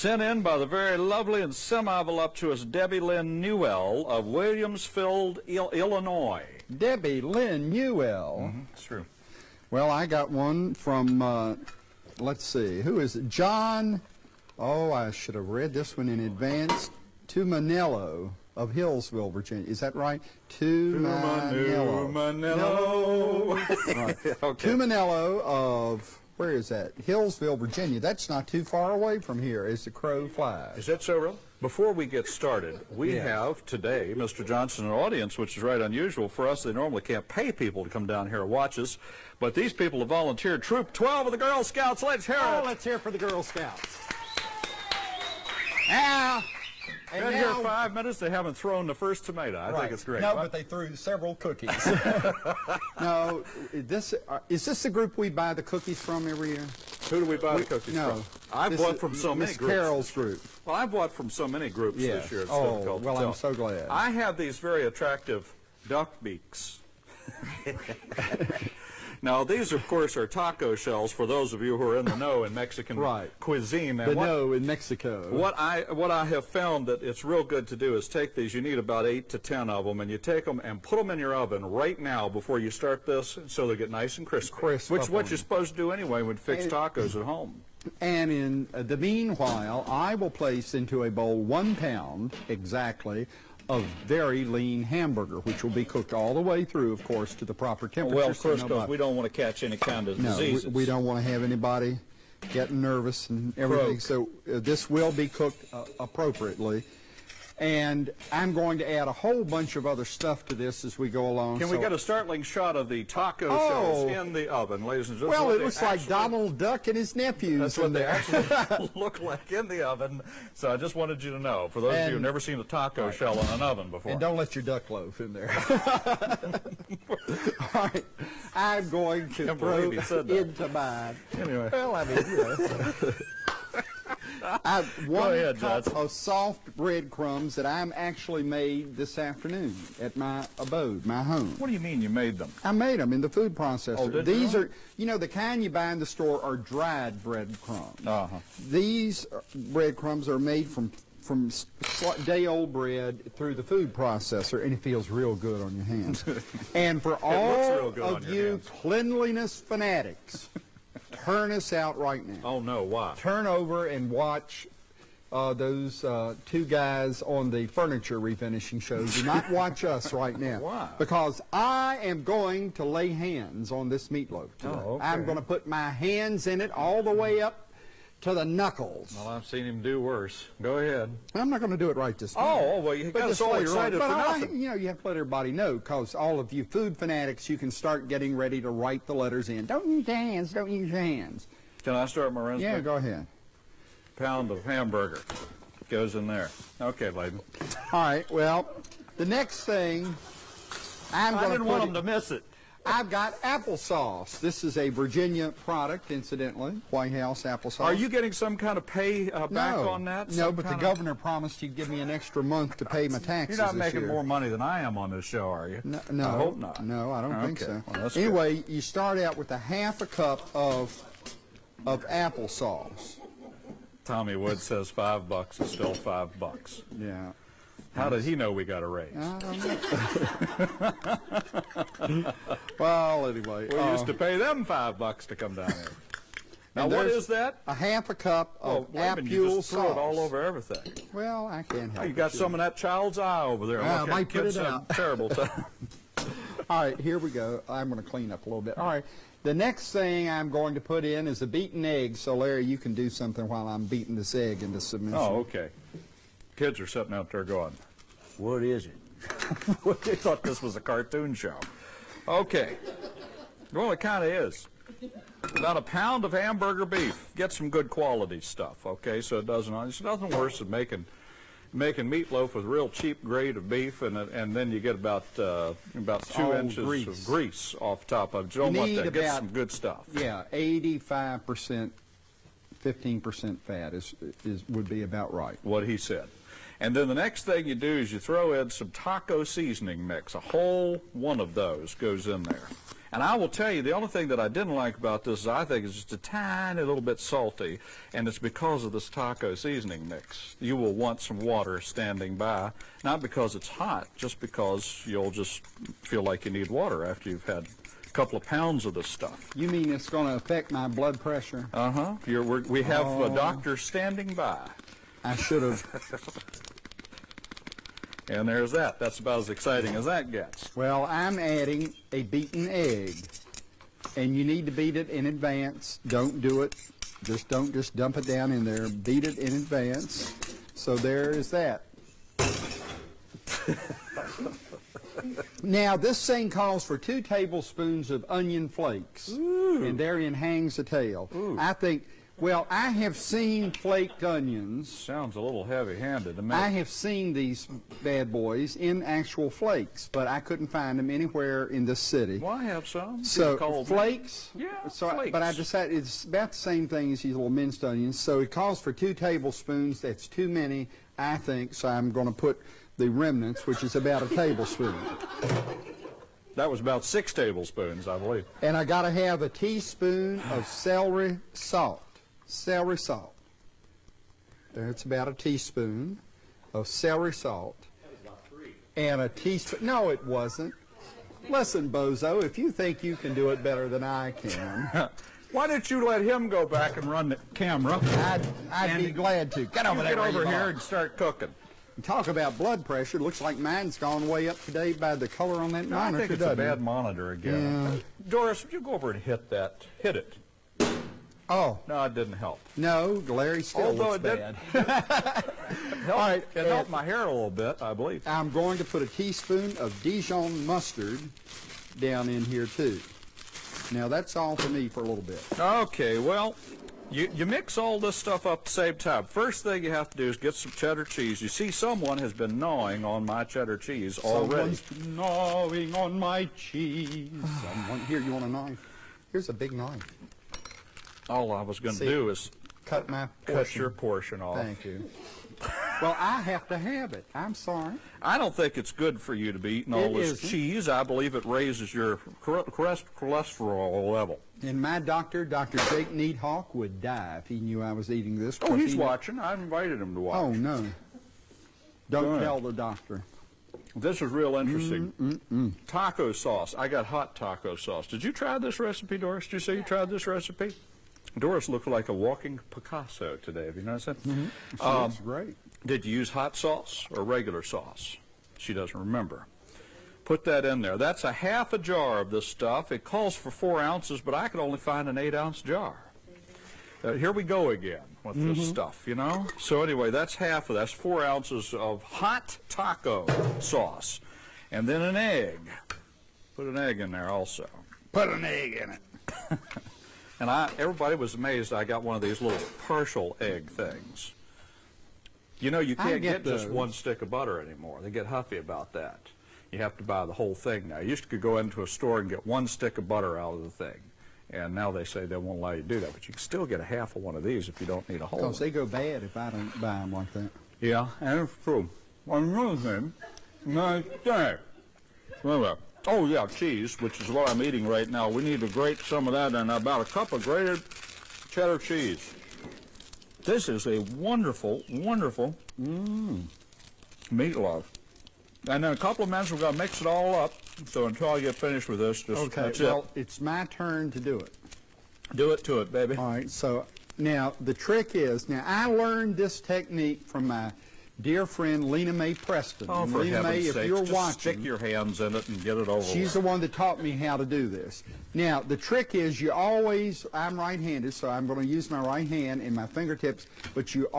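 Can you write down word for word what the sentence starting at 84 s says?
Crisp which what you're supposed to do anyway when fix tacos at home.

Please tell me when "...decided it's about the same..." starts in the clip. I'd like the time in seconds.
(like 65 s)
355 s.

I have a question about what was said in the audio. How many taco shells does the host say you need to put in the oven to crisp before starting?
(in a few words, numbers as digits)
8 to 10.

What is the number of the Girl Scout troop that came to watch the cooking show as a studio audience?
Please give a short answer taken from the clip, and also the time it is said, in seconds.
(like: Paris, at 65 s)
12, at 40 s.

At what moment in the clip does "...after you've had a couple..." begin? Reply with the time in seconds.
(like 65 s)
307 s.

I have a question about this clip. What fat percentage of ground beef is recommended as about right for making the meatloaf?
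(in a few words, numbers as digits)
15 percent.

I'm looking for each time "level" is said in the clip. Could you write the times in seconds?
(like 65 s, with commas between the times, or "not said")
444 s.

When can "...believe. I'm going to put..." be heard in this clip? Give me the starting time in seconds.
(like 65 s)
407 s.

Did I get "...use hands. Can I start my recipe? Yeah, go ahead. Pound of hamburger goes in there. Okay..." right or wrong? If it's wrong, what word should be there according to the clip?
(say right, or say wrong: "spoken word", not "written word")
right.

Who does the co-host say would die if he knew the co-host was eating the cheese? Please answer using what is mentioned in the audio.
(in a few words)
Dr. Jake Needhawk.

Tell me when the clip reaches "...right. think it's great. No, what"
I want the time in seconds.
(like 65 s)
49 s.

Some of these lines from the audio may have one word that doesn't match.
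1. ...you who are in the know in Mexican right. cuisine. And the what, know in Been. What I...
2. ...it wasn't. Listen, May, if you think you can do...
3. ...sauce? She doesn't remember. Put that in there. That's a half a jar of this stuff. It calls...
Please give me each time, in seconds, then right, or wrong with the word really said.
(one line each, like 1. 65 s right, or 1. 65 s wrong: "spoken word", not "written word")
1. 71 s wrong: "Mexico", not "Been"
2. 380 s wrong: "Bozo", not "May"
3. 467 s right.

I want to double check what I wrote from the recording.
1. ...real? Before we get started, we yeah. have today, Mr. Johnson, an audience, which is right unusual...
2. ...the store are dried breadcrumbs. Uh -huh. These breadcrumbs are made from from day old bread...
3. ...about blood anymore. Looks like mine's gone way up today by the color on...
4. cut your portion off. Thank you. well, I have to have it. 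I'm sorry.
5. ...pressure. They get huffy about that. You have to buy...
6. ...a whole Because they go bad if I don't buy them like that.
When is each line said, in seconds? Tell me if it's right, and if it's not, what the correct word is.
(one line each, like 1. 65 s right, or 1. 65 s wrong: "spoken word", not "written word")
1. 31 s right
2. 145 s right
3. 392 s wrong: "pressure", not "anymore"
4. 433 s right
5. 497 s wrong: "anymore", not "pressure"
6. 508 s right.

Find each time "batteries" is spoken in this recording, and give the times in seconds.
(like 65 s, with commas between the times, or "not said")
not said.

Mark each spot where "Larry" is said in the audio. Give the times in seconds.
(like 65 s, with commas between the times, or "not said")
252 s, 403 s.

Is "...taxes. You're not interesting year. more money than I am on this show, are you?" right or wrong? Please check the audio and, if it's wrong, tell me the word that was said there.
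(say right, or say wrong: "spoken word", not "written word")
wrong: "making", not "interesting".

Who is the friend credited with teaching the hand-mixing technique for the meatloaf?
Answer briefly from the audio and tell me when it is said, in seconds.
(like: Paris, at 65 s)
Lena Mae Preston, at 541 s.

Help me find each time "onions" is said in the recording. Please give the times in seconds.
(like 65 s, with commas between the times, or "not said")
338 s, 344 s, 357 s.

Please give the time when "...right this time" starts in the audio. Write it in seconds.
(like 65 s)
181 s.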